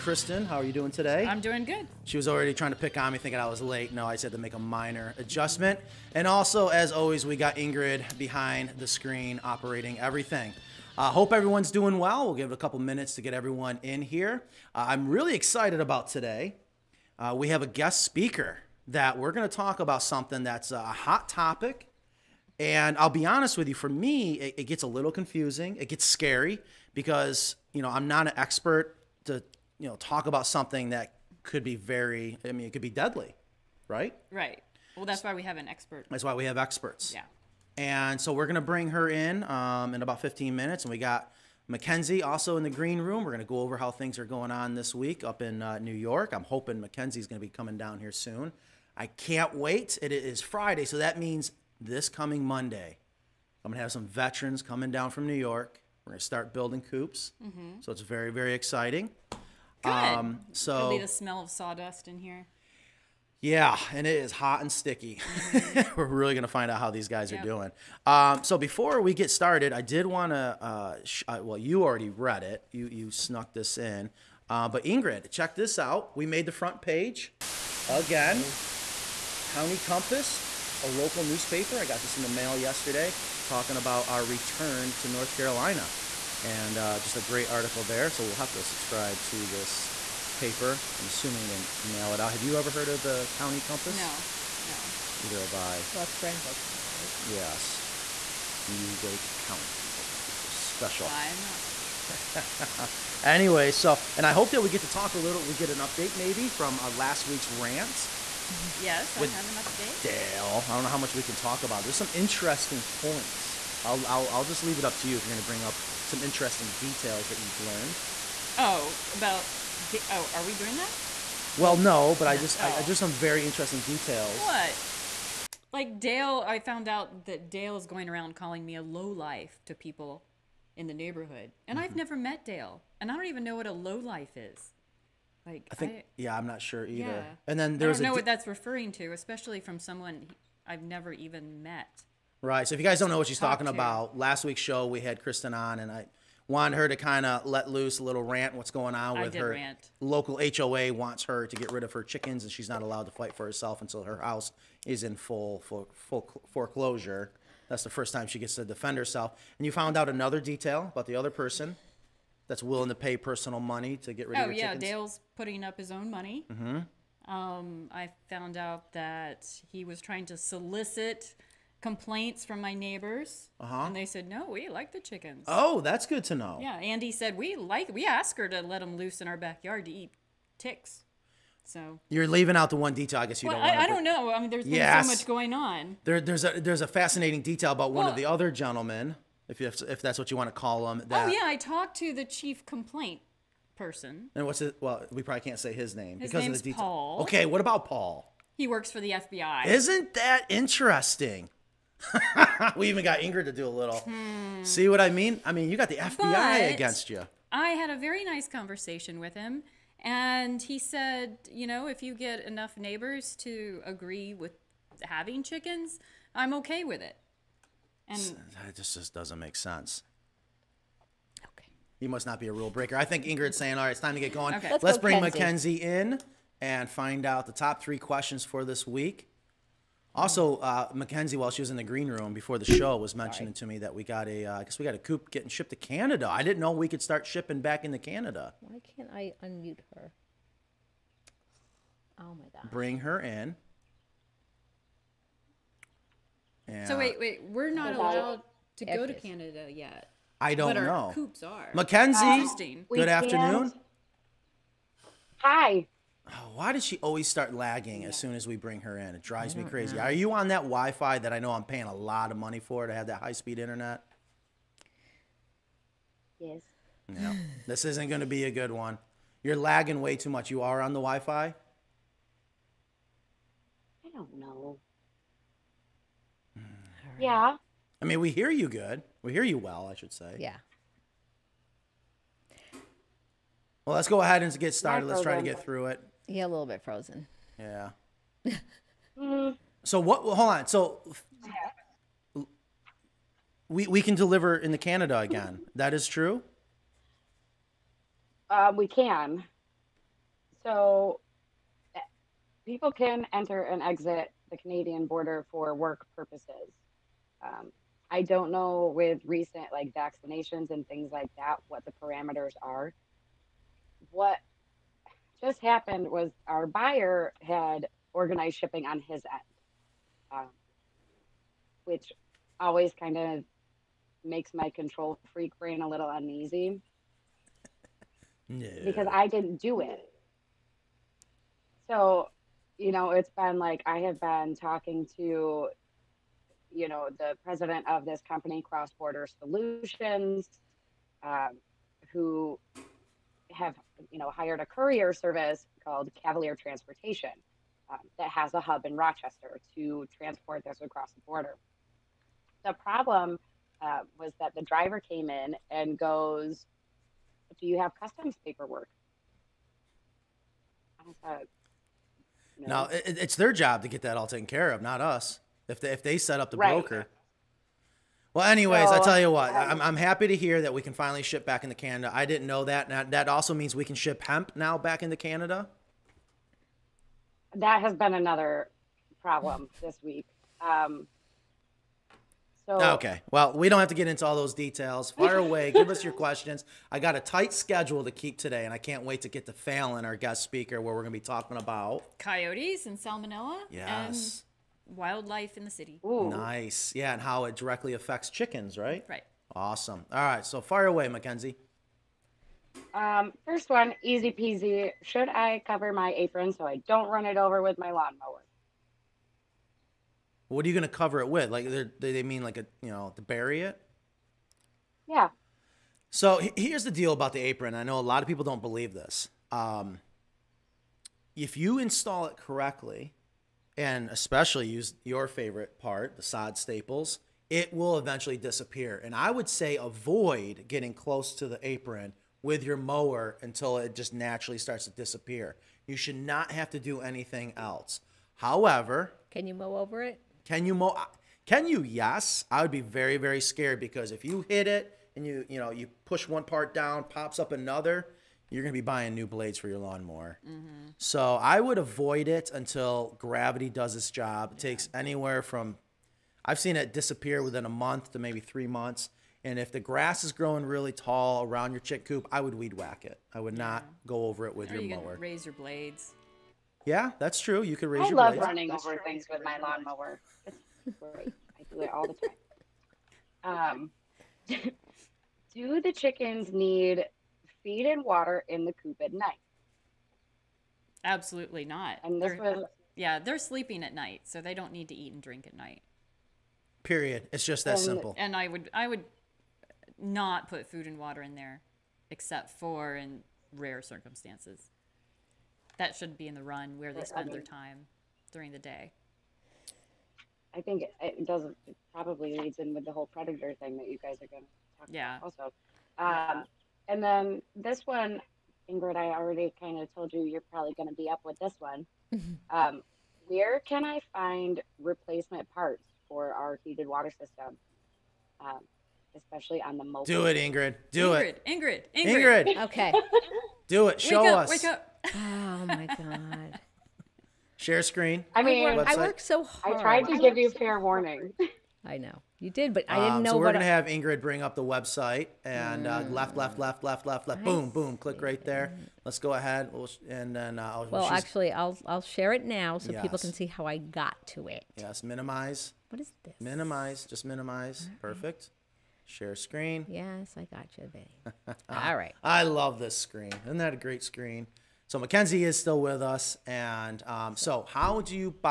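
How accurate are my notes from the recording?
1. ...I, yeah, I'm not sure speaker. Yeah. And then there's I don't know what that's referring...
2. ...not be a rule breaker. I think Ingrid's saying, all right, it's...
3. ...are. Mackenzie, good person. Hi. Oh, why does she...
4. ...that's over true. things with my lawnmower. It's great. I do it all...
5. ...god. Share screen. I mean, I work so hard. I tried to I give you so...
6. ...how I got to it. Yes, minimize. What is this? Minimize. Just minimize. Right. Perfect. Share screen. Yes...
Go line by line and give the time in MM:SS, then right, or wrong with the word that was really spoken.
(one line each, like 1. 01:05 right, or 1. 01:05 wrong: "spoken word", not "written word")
1. 02:15 wrong: "either", not "speaker"
2. 03:42 right
3. 04:11 wrong: "afternoon", not "person"
4. 07:48 right
5. 08:45 right
6. 09:03 right.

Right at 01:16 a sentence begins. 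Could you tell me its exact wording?
We made the front page again.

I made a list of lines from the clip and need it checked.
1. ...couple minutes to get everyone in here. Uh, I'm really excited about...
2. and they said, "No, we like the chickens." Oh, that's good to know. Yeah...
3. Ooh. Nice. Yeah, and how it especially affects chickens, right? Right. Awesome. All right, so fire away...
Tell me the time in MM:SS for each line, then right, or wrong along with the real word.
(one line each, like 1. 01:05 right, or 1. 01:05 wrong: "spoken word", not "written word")
1. 00:12 right
2. 02:53 right
3. 06:36 wrong: "directly", not "especially".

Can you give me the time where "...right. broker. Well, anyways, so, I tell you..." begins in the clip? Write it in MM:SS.
06:06.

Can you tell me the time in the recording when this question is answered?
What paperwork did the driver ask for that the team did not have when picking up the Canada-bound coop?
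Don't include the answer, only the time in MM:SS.
05:58.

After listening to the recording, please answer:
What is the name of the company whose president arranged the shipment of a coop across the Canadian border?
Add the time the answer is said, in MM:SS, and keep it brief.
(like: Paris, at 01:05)
Cross Border Solutions, at 05:38.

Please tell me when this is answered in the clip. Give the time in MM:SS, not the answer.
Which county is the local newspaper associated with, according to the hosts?
01:36.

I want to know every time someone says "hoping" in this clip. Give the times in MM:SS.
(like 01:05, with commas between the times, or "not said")
00:46.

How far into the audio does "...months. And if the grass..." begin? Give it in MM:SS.
07:38.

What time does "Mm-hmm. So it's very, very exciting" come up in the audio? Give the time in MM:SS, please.
00:57.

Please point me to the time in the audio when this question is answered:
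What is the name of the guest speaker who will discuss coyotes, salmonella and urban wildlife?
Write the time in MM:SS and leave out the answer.
06:29.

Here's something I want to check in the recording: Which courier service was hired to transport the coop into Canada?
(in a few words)
Cavalier Transportation.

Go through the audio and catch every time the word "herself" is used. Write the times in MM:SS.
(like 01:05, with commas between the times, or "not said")
02:33, 02:38.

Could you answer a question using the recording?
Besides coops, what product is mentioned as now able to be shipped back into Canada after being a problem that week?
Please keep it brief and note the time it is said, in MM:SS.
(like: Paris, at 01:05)
Hemp, at 06:14.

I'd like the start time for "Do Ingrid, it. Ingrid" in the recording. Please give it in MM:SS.
08:40.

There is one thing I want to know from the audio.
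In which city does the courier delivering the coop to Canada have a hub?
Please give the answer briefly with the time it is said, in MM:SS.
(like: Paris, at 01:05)
Rochester, at 05:48.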